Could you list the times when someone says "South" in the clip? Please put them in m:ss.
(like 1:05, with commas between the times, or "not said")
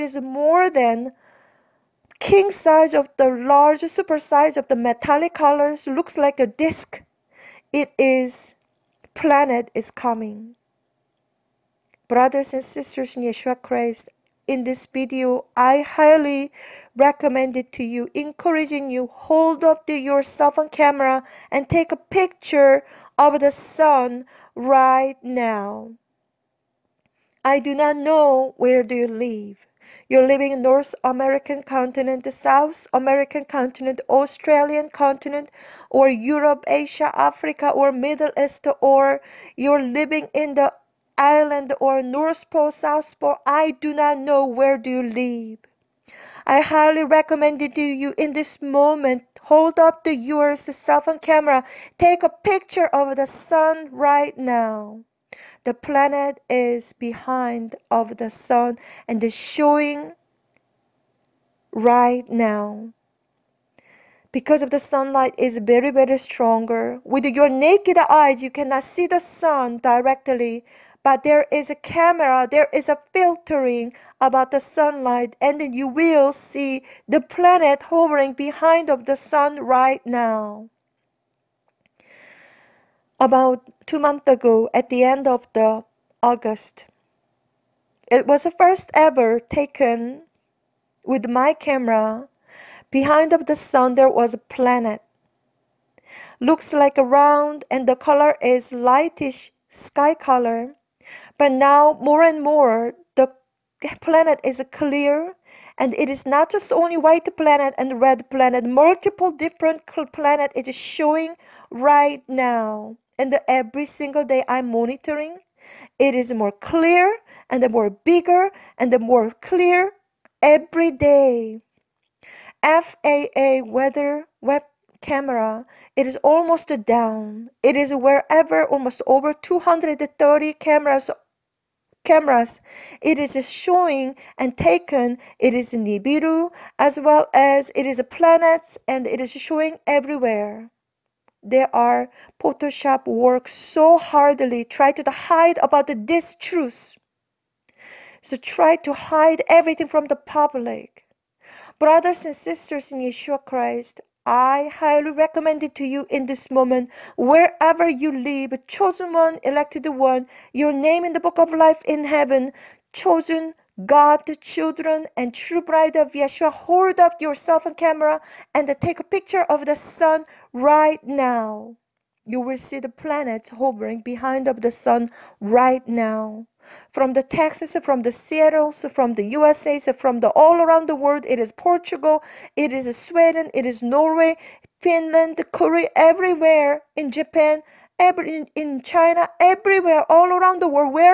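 0:32, 0:42.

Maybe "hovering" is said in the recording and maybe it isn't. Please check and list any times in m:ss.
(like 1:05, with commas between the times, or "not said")
1:17, 2:53.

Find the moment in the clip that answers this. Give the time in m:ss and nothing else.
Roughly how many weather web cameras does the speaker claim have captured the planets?
2:09.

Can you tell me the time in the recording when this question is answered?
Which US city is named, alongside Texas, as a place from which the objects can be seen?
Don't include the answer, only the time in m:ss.
2:58.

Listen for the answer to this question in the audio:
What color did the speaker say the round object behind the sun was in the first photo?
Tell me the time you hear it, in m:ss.
1:38.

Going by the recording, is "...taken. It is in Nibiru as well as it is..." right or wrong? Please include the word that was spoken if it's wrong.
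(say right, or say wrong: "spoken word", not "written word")
right.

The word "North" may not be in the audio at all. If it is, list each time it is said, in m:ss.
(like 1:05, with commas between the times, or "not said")
0:30, 0:42.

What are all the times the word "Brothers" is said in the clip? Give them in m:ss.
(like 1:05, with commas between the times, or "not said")
0:12, 2:31.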